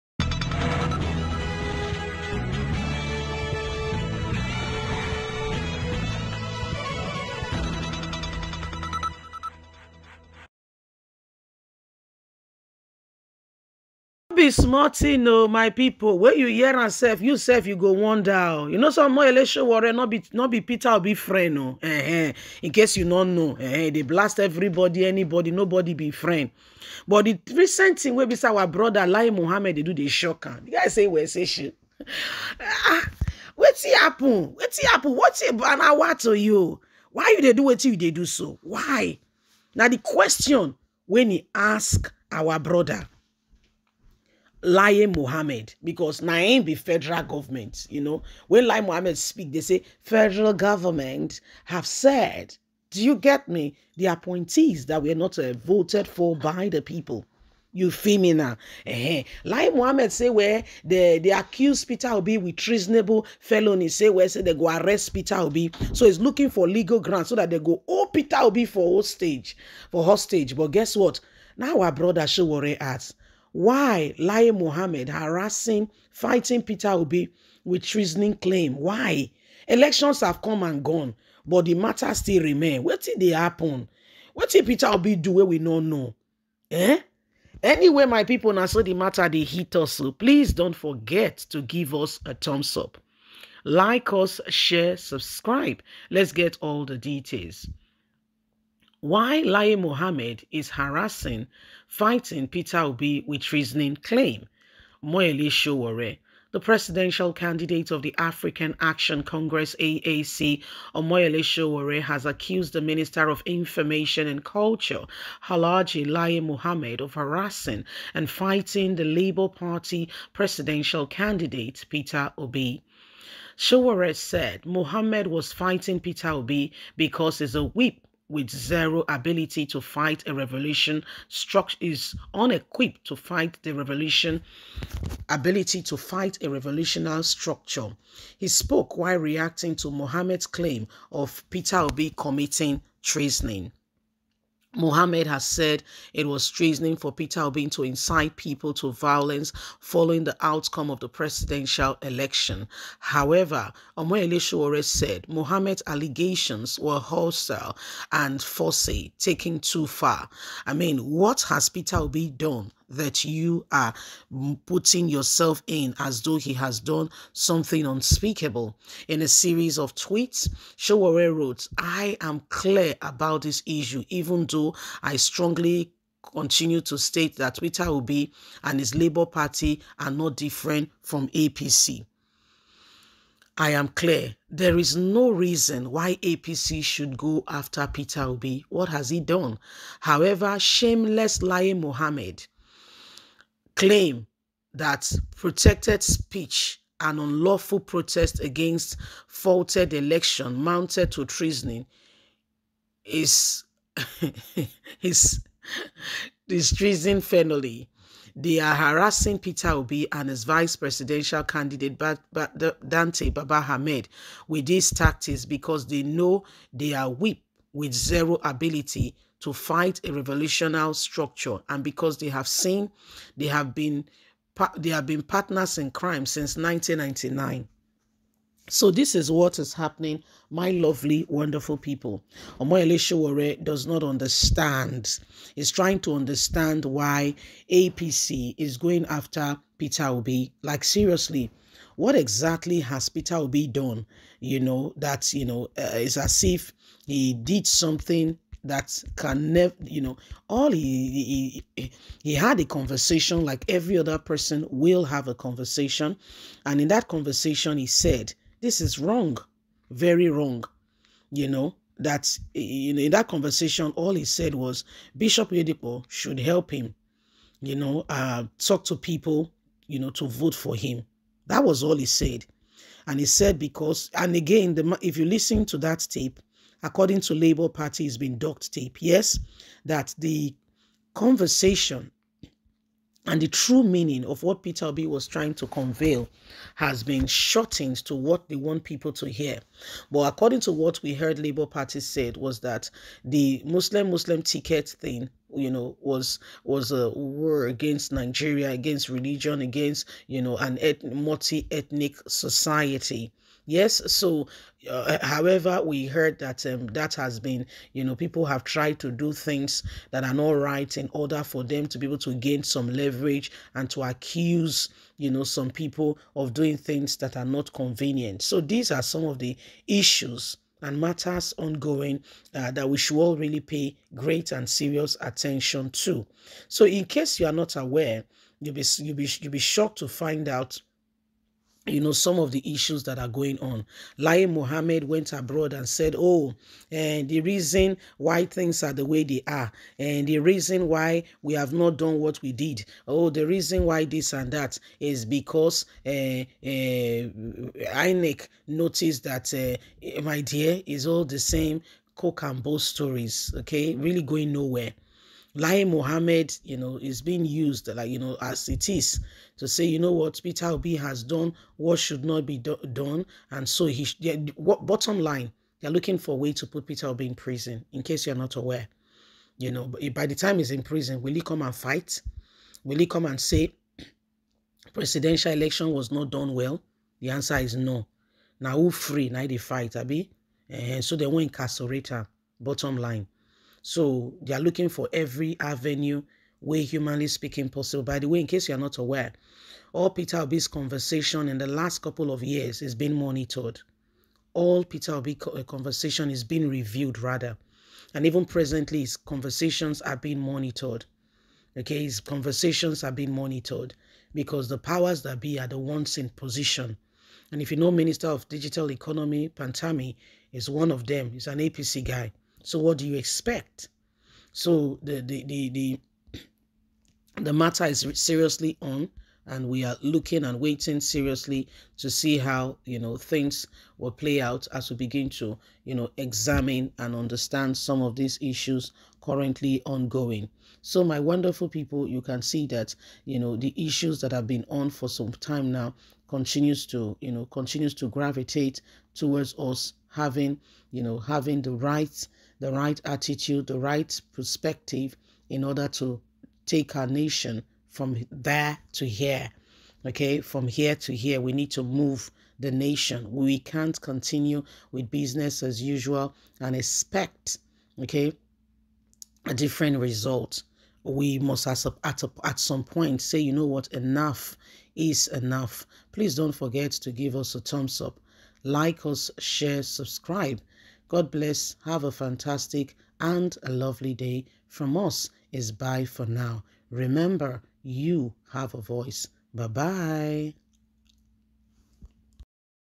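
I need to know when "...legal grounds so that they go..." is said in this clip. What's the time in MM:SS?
01:06.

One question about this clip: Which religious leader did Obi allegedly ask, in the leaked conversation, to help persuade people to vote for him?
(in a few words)
Bishop Oyedepo.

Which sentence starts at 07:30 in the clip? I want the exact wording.
Okay, from here to here, we need to move the nation.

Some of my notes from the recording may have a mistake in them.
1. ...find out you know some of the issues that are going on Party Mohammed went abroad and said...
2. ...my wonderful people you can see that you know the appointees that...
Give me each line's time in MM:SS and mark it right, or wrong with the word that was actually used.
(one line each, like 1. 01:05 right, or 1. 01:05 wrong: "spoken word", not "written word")
1. 05:30 wrong: "Lai", not "Party"
2. 07:11 wrong: "issues", not "appointees".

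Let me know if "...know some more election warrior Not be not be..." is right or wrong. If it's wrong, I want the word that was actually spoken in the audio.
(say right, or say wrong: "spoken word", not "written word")
right.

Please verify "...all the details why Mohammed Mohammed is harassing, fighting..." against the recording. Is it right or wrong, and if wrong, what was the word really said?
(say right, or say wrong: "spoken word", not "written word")
wrong: "Lai", not "Mohammed".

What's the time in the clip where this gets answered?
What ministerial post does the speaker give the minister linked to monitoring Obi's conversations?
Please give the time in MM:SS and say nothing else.
06:47.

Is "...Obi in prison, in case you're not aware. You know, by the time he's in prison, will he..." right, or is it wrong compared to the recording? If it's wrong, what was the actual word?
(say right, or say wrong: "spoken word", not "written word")
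right.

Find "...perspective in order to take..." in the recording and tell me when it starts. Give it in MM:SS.
07:24.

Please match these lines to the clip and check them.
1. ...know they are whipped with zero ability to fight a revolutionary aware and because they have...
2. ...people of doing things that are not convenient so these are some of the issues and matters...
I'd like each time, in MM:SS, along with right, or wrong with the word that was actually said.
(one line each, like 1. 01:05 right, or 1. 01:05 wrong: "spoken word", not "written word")
1. 03:36 wrong: "structure", not "aware"
2. 05:15 right.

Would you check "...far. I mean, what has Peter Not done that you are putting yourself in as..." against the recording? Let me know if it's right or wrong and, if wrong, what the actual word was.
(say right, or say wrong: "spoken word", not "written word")
wrong: "Obi", not "Not".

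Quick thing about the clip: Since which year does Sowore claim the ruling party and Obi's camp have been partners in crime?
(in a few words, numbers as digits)
1999.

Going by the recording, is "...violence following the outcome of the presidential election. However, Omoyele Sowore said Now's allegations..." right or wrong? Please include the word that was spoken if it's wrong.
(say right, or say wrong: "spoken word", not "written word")
wrong: "Mohammed", not "Now".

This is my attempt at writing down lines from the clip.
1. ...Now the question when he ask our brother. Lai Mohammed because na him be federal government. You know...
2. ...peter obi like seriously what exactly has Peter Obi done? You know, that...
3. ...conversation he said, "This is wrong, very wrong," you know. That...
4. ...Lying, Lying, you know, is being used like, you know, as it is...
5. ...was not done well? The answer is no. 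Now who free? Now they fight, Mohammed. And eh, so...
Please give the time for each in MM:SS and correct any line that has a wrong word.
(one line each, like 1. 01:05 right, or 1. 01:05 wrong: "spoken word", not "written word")
1. 00:39 right
2. 03:59 right
3. 04:17 right
4. 05:55 wrong: "Mohammed", not "Lying"
5. 06:15 wrong: "Abi", not "Mohammed".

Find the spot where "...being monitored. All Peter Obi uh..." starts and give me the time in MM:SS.
06:32.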